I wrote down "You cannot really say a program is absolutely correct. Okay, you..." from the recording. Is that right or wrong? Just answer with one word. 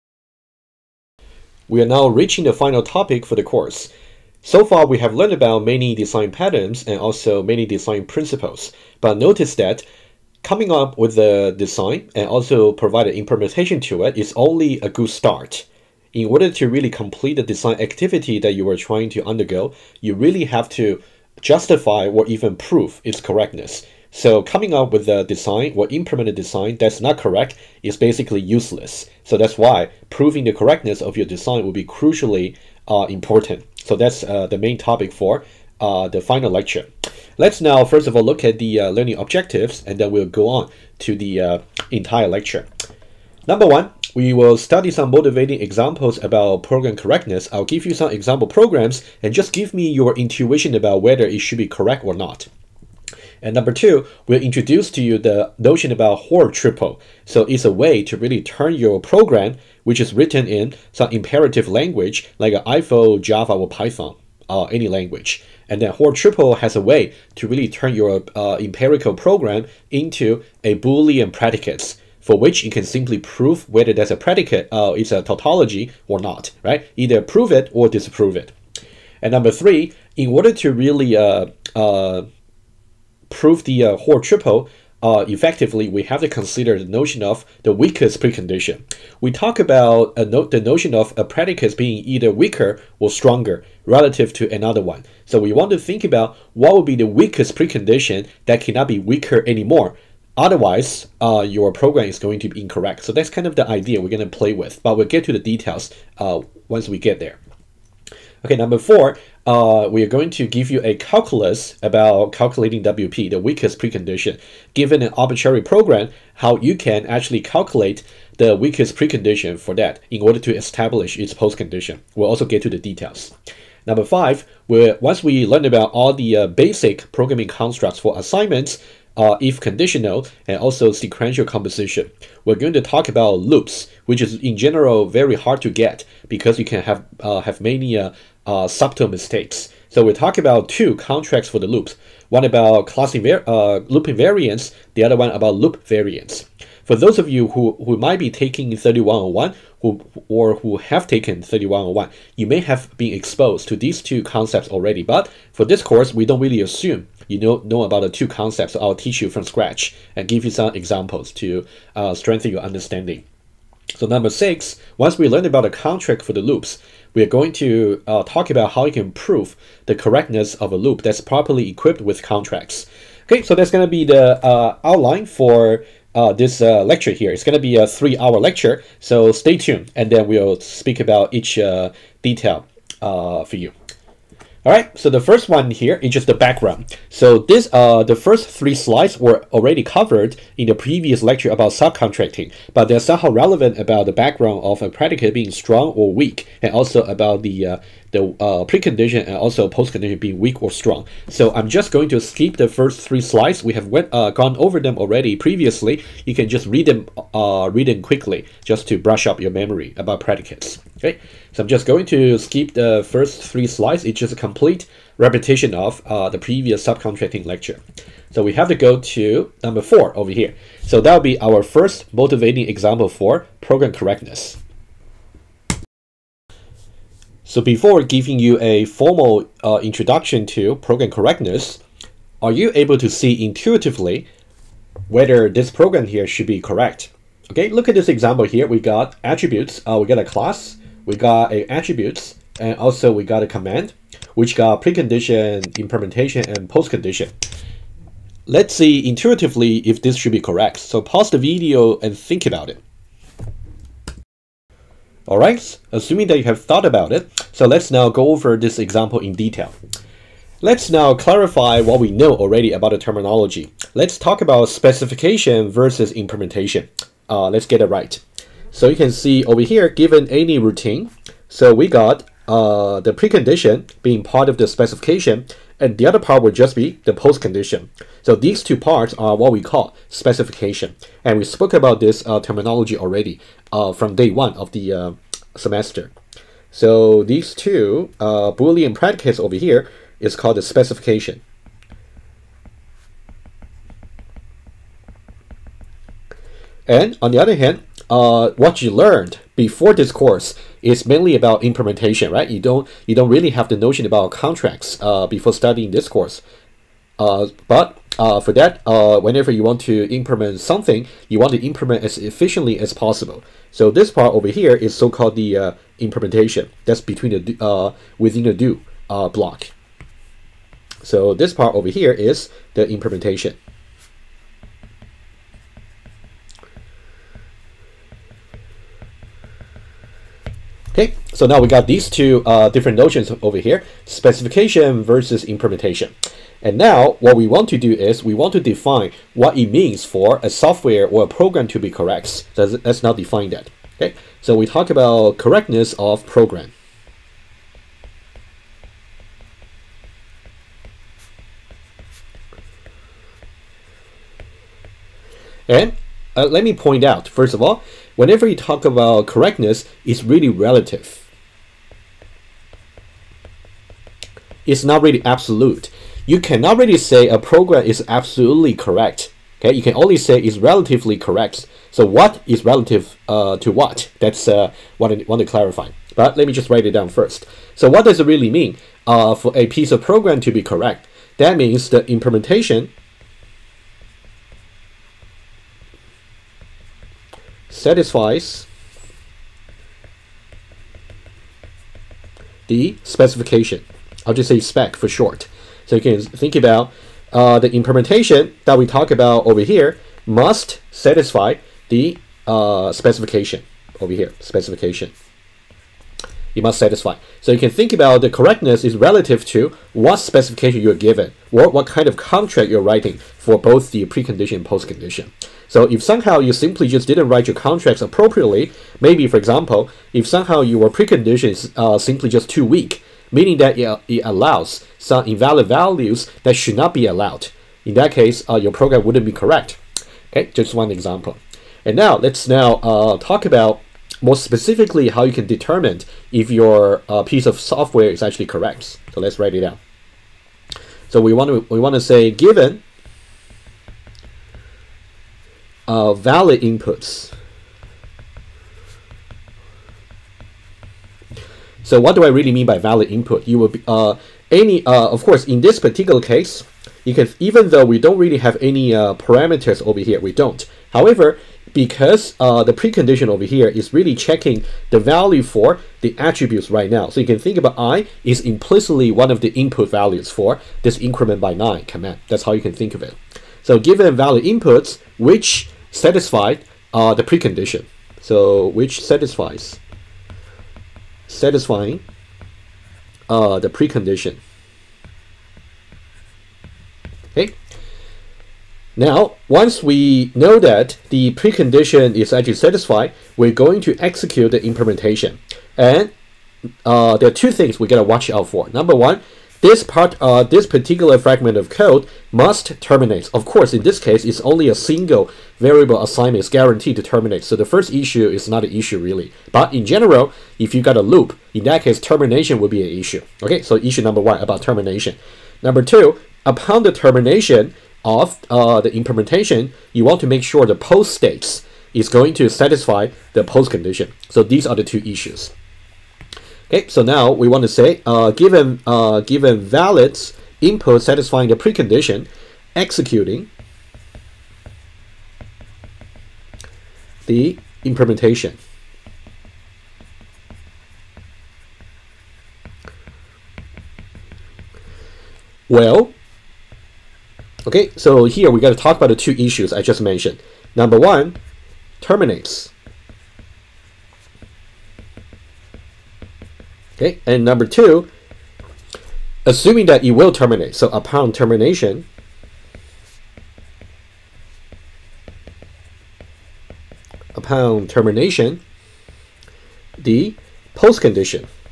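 right.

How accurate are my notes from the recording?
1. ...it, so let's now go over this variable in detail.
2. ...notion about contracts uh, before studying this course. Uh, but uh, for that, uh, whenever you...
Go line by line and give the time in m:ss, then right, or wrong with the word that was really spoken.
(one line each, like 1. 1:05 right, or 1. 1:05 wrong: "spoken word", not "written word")
1. 4:17 wrong: "example", not "variable"
2. 5:03 right.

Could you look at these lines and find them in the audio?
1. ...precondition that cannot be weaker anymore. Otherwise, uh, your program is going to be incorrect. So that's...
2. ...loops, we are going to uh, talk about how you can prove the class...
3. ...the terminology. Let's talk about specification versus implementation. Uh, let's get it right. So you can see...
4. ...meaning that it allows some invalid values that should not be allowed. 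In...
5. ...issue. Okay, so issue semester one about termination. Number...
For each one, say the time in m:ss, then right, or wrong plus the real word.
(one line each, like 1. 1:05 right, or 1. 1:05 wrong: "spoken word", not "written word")
1. 1:37 right
2. 2:46 wrong: "correctness", not "class"
3. 4:22 right
4. 7:03 right
5. 8:32 wrong: "number", not "semester".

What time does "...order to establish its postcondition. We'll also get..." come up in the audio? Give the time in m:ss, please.
2:00.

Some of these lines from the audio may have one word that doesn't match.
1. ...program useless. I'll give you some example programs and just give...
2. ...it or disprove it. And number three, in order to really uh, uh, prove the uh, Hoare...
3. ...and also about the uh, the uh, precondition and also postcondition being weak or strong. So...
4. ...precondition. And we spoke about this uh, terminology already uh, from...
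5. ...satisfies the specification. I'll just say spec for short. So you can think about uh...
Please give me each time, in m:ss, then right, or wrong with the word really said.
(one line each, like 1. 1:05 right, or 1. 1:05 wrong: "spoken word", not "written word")
1. 0:46 wrong: "correctness", not "useless"
2. 1:17 right
3. 3:16 right
4. 4:40 wrong: "specification", not "precondition"
5. 6:27 right.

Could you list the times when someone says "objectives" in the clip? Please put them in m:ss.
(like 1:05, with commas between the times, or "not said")
0:39.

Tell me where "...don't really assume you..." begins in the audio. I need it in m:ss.
2:36.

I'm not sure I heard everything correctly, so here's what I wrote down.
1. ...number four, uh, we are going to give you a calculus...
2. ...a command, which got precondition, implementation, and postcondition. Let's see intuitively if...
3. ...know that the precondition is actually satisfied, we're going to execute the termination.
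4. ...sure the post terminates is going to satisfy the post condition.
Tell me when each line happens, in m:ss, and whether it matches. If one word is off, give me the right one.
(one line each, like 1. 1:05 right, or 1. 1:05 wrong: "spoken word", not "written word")
1. 1:48 right
2. 4:03 right
3. 8:10 wrong: "implementation", not "termination"
4. 8:40 wrong: "states", not "terminates".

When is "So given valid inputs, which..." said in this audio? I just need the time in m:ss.
7:53.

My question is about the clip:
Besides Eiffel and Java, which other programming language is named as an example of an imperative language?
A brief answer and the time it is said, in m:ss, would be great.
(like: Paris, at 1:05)
Python, at 1:03.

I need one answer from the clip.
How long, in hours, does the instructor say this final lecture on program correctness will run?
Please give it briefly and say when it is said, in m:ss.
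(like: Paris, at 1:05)
3, at 2:57.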